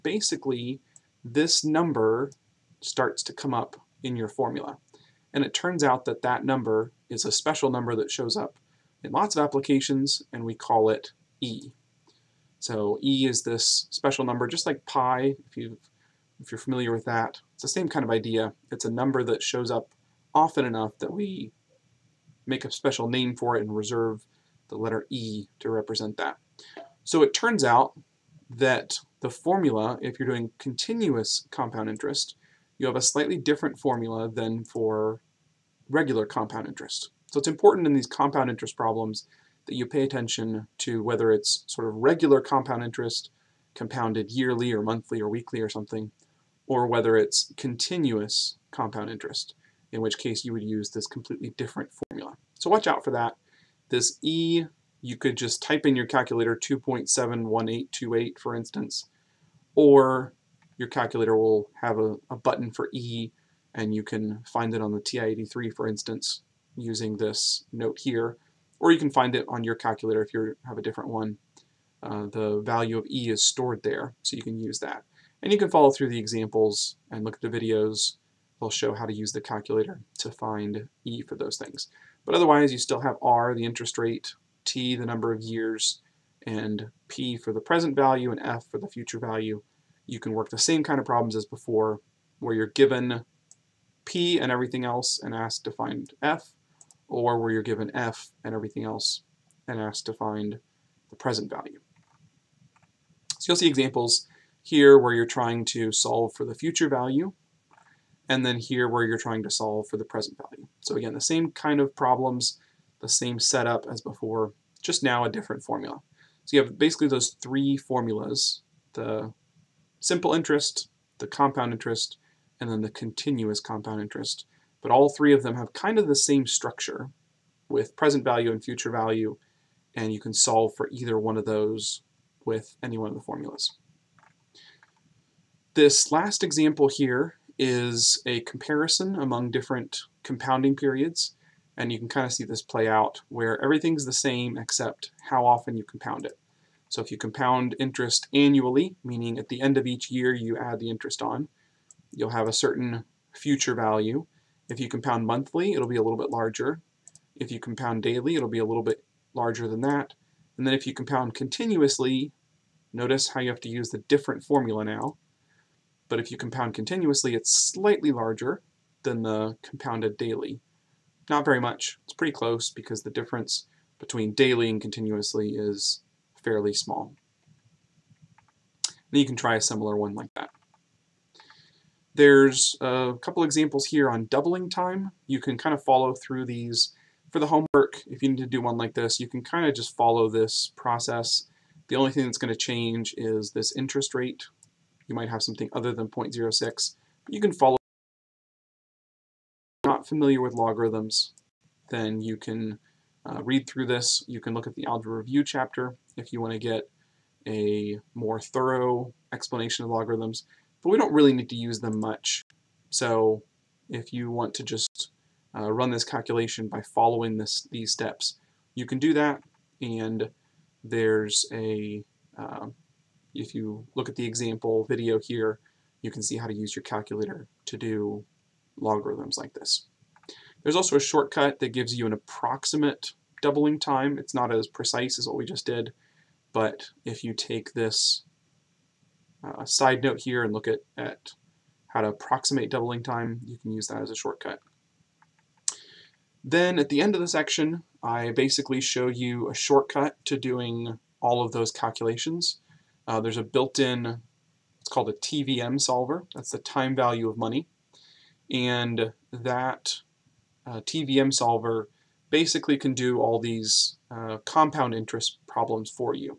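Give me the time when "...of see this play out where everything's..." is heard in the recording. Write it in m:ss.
2:22.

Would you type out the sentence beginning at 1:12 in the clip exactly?
Uh, the value of E is stored there so you can use that.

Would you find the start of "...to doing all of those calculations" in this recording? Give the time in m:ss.
4:10.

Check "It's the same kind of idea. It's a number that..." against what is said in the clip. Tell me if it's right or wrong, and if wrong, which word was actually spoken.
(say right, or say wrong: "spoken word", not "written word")
right.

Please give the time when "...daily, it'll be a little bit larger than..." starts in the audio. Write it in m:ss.
2:38.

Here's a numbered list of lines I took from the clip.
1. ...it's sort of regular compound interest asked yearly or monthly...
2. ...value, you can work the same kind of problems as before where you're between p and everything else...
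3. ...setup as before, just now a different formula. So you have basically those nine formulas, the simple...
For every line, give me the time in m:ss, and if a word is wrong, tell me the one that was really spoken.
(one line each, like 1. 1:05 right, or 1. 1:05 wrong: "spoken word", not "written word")
1. 0:41 wrong: "compounded", not "asked"
2. 1:29 wrong: "given", not "between"
3. 1:53 wrong: "three", not "nine".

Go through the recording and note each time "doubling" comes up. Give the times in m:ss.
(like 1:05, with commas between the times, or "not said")
3:04, 3:53, 4:02.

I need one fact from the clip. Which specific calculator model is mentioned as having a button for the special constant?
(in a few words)
TI-83.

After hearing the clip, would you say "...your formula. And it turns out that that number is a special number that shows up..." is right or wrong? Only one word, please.
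right.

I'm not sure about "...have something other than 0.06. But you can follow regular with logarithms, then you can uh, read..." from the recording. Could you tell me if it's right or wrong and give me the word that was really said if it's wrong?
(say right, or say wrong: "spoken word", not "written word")
wrong: "familiar", not "regular".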